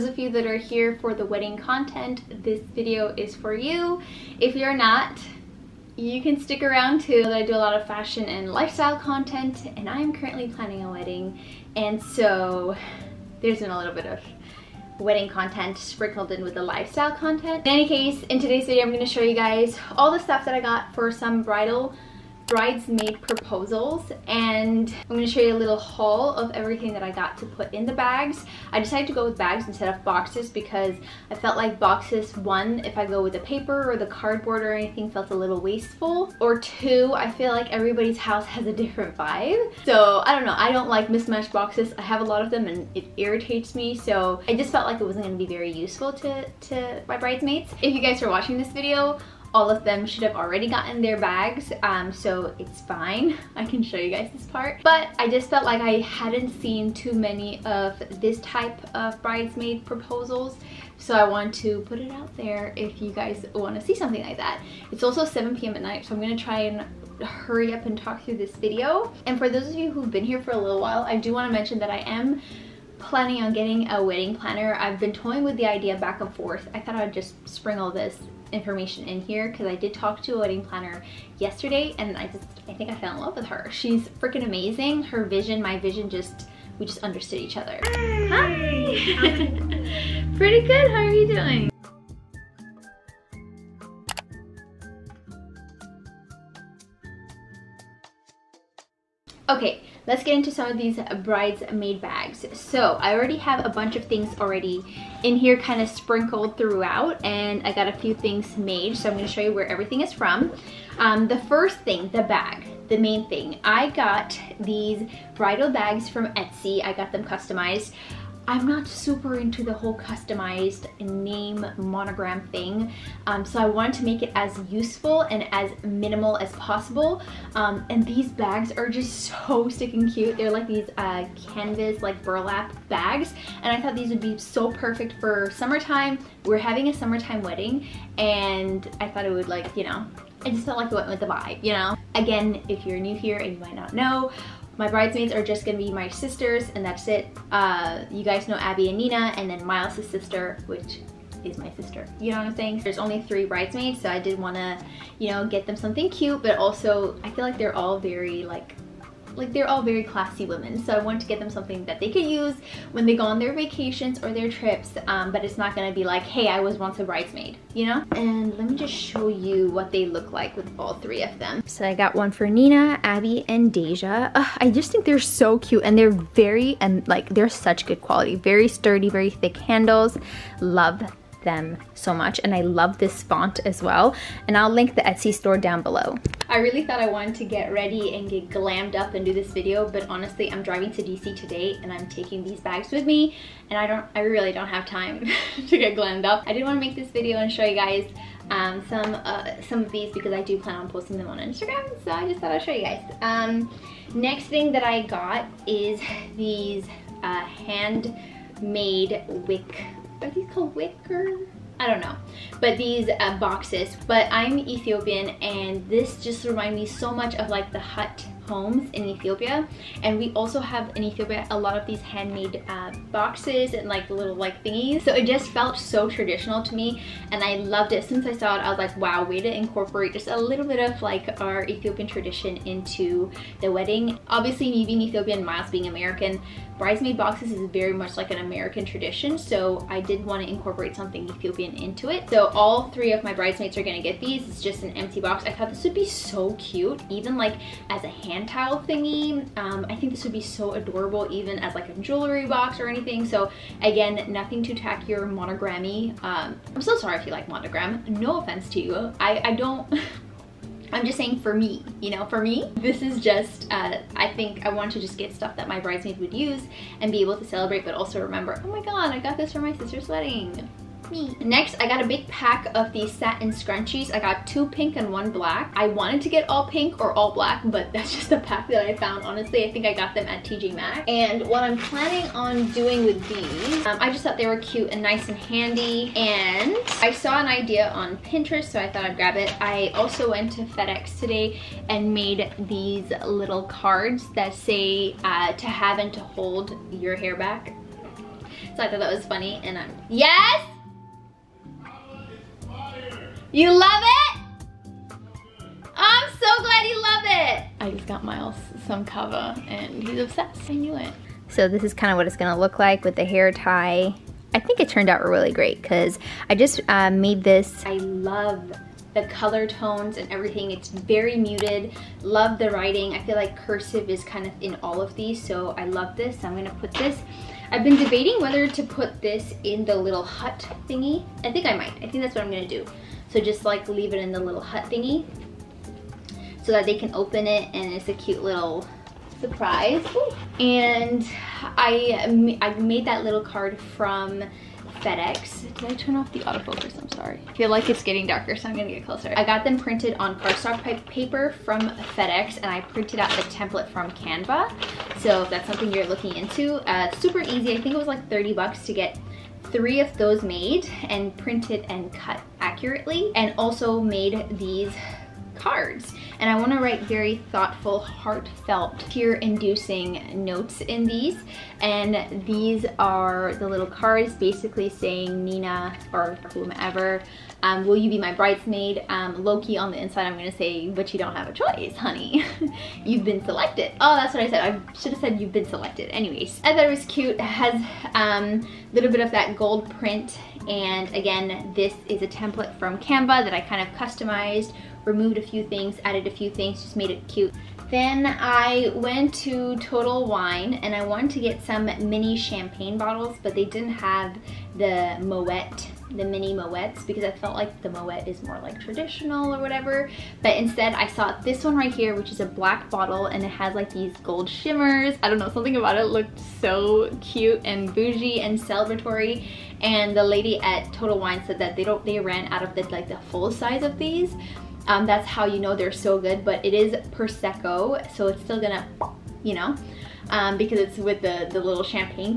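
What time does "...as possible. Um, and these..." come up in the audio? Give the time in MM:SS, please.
02:06.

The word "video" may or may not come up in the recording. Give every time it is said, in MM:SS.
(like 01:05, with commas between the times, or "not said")
00:02, 00:18, 00:48, 01:08, 03:09, 03:17.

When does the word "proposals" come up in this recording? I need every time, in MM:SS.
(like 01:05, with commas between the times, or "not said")
00:23, 00:59.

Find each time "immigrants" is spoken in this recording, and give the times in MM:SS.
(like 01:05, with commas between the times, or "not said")
not said.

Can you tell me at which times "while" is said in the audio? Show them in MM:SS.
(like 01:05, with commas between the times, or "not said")
01:10.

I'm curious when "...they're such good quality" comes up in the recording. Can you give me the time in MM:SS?
02:57.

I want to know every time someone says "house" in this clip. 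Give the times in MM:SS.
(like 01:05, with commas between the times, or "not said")
00:38.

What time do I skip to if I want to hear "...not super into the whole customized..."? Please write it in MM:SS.
01:58.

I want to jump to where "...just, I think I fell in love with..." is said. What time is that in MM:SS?
01:22.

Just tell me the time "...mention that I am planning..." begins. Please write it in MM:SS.
01:11.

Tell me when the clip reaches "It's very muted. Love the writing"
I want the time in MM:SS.
05:20.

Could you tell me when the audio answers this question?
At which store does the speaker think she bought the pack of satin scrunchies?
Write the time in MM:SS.
04:40.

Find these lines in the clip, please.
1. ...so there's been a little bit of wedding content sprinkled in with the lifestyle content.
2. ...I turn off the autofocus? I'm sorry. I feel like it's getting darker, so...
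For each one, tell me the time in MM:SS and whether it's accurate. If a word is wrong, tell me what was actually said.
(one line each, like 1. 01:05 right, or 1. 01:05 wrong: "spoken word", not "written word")
1. 00:11 right
2. 05:45 right.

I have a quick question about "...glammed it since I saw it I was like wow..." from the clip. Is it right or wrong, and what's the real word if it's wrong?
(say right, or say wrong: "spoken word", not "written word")
wrong: "loved", not "glammed".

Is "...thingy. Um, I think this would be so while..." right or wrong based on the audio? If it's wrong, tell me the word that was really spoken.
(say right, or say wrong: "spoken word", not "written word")
wrong: "adorable", not "while".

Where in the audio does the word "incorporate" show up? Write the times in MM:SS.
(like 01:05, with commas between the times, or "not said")
03:49, 04:00.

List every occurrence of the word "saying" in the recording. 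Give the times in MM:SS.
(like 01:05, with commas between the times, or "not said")
02:32, 04:21, 06:14.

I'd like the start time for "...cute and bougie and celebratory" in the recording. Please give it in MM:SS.
06:57.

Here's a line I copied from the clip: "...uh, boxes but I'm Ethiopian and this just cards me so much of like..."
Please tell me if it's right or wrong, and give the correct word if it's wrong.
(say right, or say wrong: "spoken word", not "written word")
wrong: "reminds", not "cards".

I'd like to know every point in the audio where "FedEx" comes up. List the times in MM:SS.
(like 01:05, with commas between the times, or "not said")
04:50, 05:45, 05:51.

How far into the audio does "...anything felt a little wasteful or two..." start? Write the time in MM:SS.
00:34.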